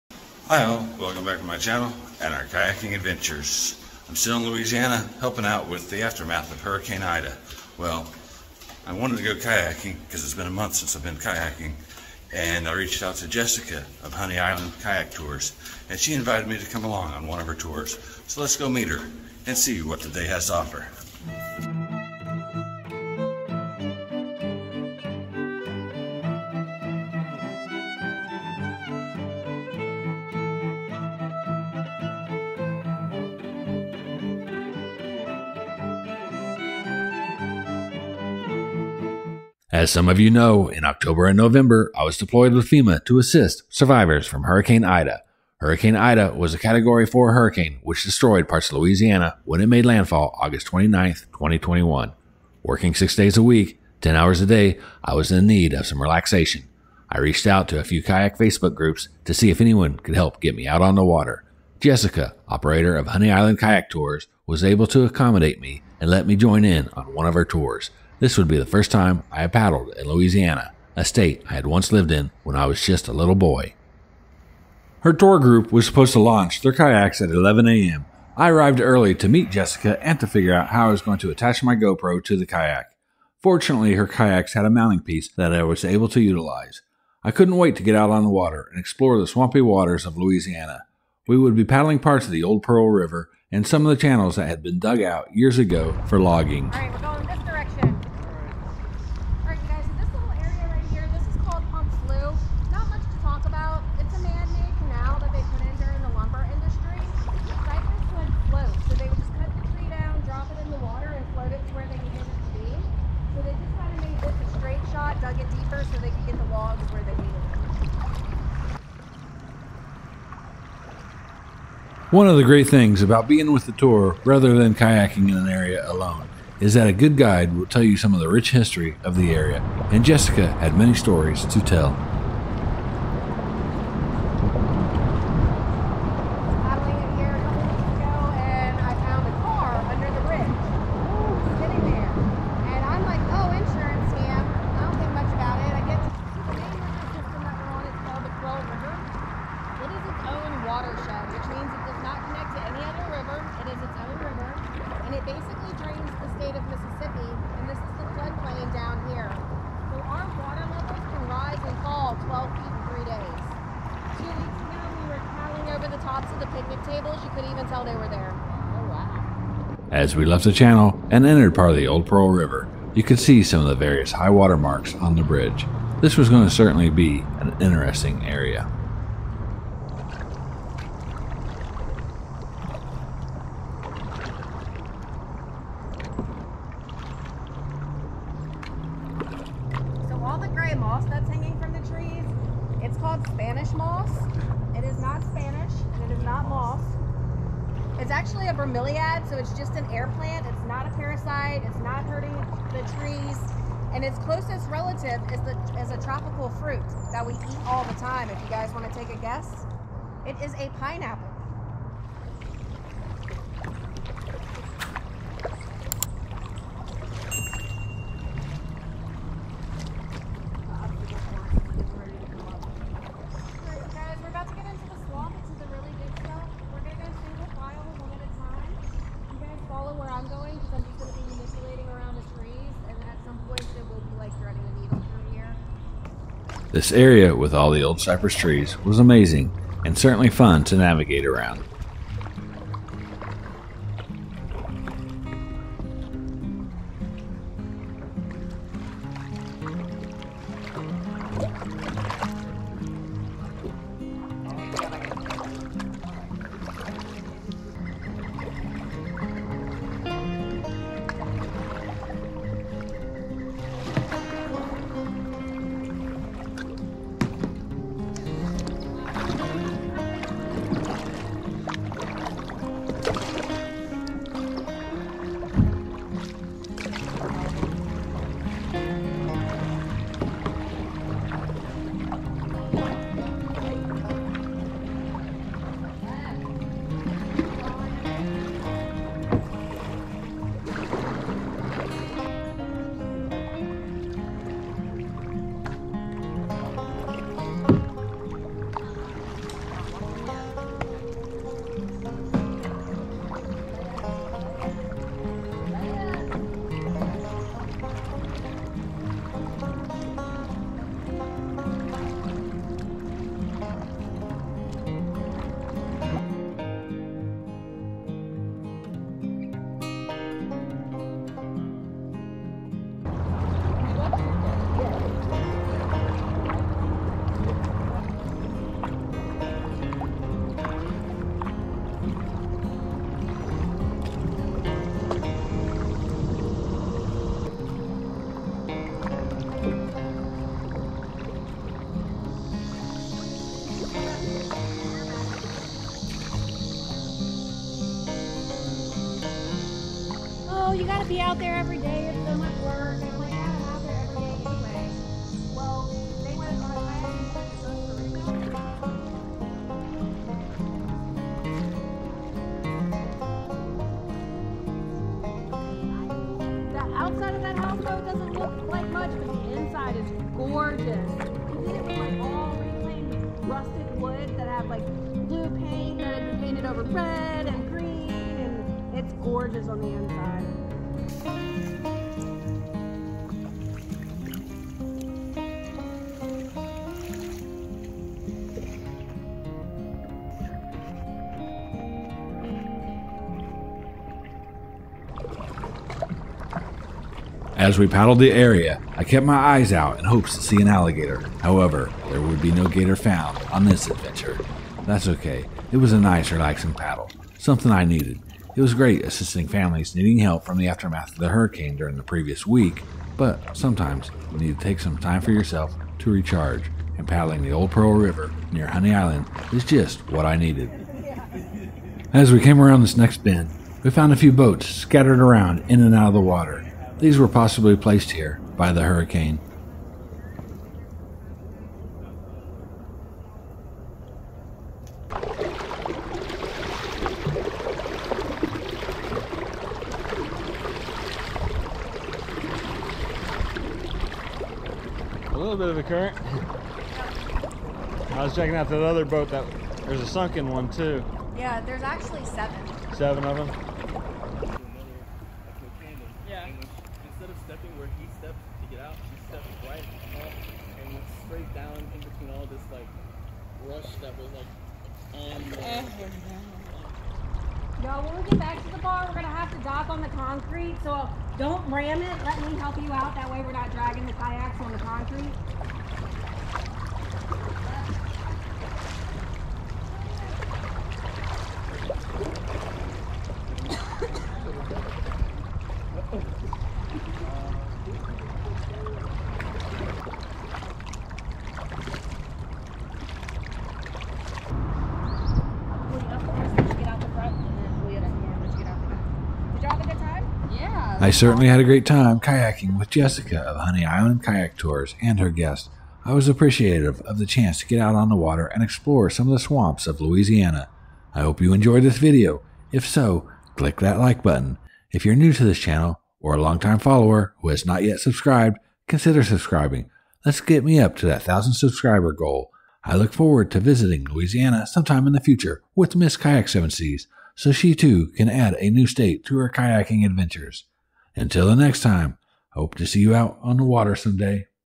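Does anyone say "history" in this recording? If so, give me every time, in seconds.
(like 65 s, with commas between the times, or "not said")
128 s.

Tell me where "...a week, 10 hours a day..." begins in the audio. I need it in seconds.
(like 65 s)
53 s.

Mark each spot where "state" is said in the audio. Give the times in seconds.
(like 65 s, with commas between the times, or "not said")
71 s, 156 s, 528 s.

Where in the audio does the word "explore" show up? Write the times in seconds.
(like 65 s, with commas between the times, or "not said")
88 s, 508 s.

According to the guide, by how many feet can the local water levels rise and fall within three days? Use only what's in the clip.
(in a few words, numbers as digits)
12.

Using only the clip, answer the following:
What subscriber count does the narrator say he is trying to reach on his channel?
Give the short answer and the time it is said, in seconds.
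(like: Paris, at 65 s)
1,000, at 521 s.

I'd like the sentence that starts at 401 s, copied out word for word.
However, there would be no gator found on this adventure.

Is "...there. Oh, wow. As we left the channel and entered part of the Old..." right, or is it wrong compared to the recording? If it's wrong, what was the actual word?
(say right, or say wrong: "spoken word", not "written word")
right.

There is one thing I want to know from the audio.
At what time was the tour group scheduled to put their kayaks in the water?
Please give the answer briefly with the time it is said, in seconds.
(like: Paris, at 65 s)
11 a.m., at 77 s.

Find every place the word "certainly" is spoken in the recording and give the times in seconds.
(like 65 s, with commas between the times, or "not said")
176 s, 239 s, 501 s.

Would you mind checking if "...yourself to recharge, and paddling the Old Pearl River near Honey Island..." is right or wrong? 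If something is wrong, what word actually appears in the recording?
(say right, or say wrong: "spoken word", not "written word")
right.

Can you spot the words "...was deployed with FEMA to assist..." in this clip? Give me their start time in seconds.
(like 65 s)
42 s.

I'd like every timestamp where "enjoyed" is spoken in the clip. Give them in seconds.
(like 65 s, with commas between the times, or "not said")
511 s.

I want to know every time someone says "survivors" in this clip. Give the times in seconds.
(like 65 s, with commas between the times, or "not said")
43 s.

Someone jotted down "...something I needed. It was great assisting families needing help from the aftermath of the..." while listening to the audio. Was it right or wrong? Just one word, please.
right.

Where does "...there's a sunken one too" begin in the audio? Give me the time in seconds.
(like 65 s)
449 s.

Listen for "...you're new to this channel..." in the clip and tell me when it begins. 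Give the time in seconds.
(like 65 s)
515 s.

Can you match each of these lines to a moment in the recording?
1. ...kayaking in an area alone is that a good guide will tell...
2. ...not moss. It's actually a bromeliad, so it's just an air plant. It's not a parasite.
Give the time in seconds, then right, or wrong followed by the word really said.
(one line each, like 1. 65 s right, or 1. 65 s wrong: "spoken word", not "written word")
1. 124 s right
2. 196 s right.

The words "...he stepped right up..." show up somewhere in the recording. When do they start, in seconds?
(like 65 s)
459 s.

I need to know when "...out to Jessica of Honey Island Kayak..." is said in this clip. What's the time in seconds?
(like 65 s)
13 s.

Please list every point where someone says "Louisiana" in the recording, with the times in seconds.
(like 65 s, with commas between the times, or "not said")
4 s, 48 s, 70 s, 90 s, 509 s, 524 s.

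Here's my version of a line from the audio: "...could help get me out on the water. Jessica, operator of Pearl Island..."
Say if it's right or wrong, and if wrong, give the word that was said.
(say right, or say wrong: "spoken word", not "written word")
wrong: "Honey", not "Pearl".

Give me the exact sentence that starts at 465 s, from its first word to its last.
Eh, you when we get back to the bar, we're gonna have to dock on the concrete, so don't ram it.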